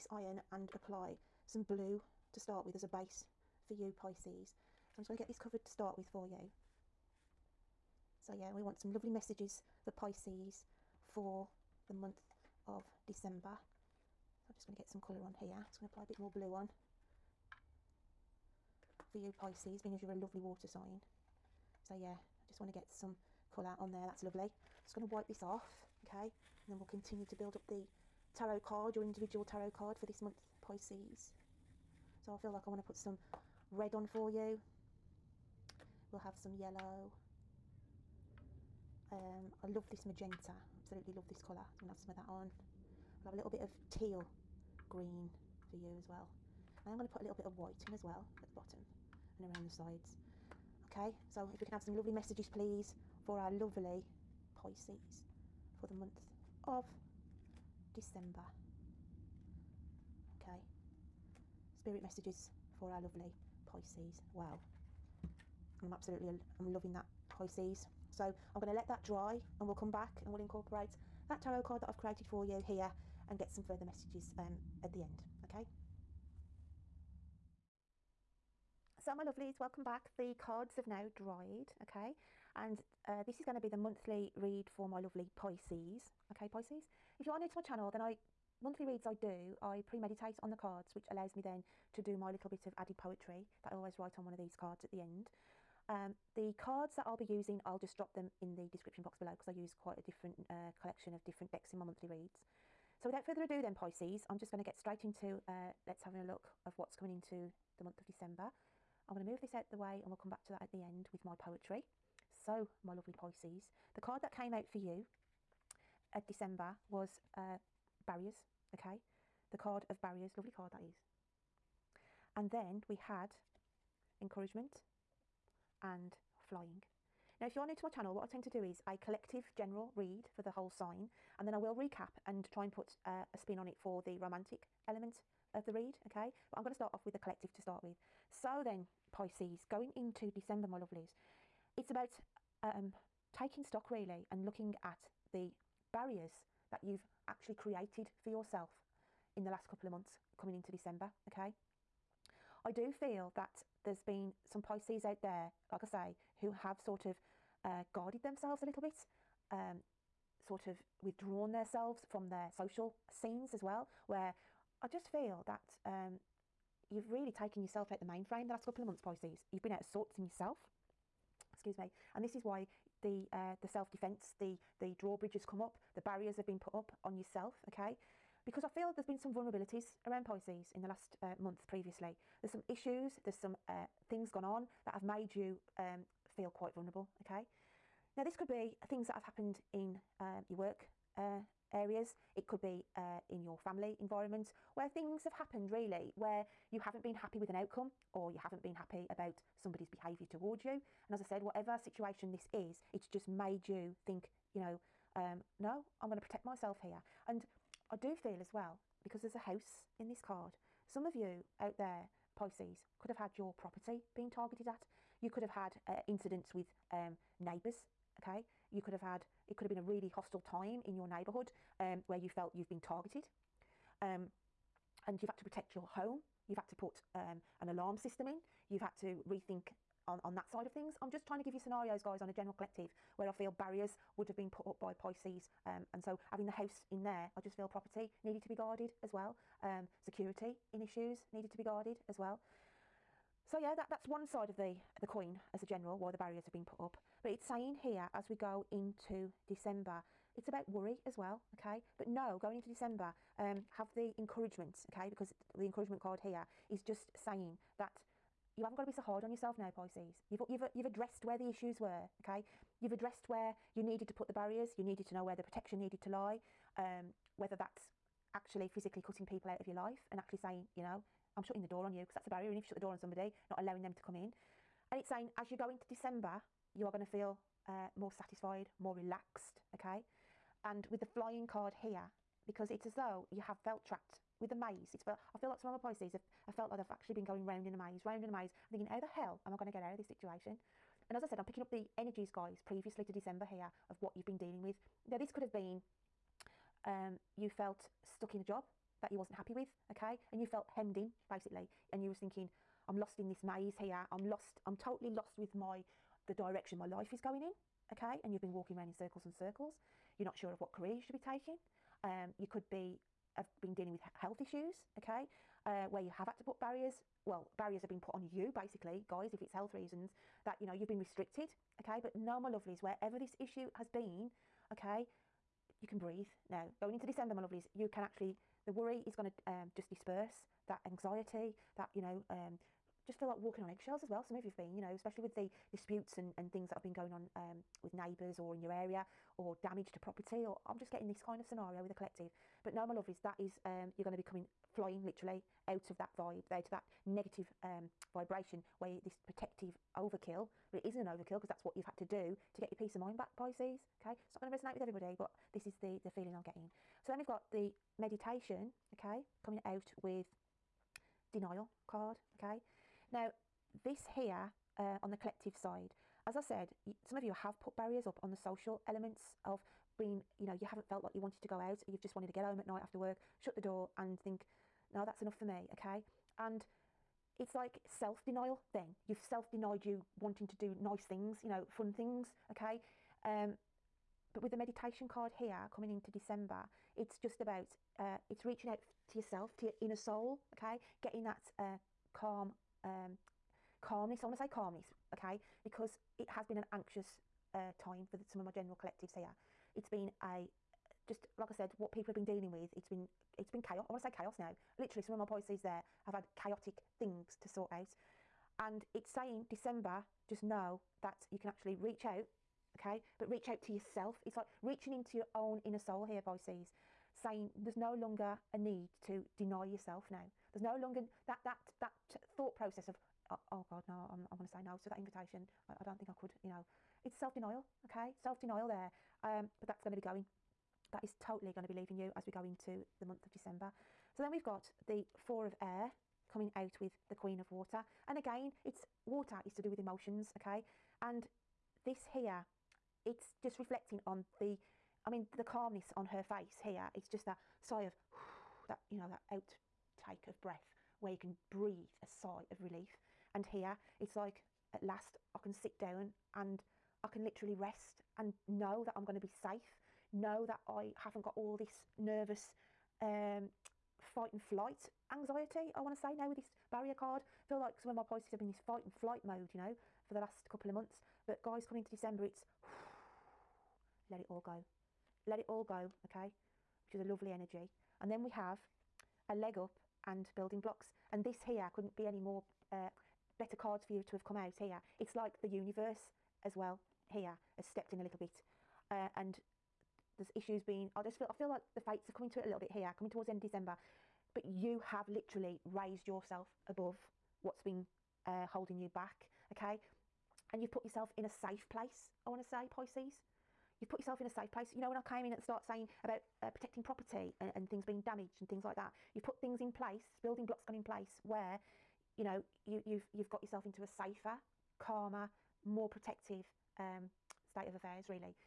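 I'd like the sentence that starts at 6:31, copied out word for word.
Getting that uh, calm, um, calmness.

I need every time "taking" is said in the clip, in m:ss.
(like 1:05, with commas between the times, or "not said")
2:23, 5:11.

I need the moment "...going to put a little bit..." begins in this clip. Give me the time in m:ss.
0:46.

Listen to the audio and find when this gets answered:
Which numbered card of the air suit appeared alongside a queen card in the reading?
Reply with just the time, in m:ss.
7:15.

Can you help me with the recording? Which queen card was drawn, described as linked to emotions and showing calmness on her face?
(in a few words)
Queen of Water.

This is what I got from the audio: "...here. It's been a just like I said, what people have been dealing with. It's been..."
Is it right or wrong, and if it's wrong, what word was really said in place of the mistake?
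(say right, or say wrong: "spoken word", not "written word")
right.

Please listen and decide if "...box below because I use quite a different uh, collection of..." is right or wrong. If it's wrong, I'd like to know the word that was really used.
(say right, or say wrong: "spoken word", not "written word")
right.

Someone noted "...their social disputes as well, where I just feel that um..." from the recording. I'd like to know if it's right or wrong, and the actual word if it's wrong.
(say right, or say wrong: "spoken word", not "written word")
wrong: "scenes", not "disputes".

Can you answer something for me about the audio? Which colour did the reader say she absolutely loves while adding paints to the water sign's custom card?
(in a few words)
magenta.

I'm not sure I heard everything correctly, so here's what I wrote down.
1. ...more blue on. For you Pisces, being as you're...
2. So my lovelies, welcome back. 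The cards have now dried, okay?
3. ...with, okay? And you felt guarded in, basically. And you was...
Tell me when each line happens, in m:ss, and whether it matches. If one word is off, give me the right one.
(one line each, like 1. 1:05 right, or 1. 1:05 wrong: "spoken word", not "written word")
1. 0:16 right
2. 1:18 right
3. 4:59 wrong: "hemmed", not "guarded".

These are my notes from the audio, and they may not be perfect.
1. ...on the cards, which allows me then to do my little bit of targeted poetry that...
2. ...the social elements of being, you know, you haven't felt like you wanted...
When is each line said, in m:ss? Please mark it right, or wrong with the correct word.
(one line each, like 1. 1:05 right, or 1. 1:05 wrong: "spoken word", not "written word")
1. 1:30 wrong: "added", not "targeted"
2. 6:08 right.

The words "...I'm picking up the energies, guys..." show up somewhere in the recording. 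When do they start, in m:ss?
4:51.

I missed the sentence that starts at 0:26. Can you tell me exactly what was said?
And then we'll continue to build up the tarot card, your individual tarot card for this month, Pisces.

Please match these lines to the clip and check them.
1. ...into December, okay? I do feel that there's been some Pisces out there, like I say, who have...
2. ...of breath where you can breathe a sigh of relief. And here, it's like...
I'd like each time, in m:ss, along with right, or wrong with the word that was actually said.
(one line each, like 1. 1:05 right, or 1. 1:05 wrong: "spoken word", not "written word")
1. 2:30 right
2. 7:30 right.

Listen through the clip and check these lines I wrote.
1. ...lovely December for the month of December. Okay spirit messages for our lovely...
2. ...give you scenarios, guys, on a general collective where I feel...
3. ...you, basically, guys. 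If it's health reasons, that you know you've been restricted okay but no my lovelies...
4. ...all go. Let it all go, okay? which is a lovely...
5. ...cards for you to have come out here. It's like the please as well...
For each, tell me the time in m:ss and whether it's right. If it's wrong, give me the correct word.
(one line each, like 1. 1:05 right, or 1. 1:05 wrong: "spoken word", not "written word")
1. 0:53 wrong: "Pisces", not "December"
2. 3:51 right
3. 5:18 right
4. 7:54 right
5. 8:03 wrong: "universe", not "please".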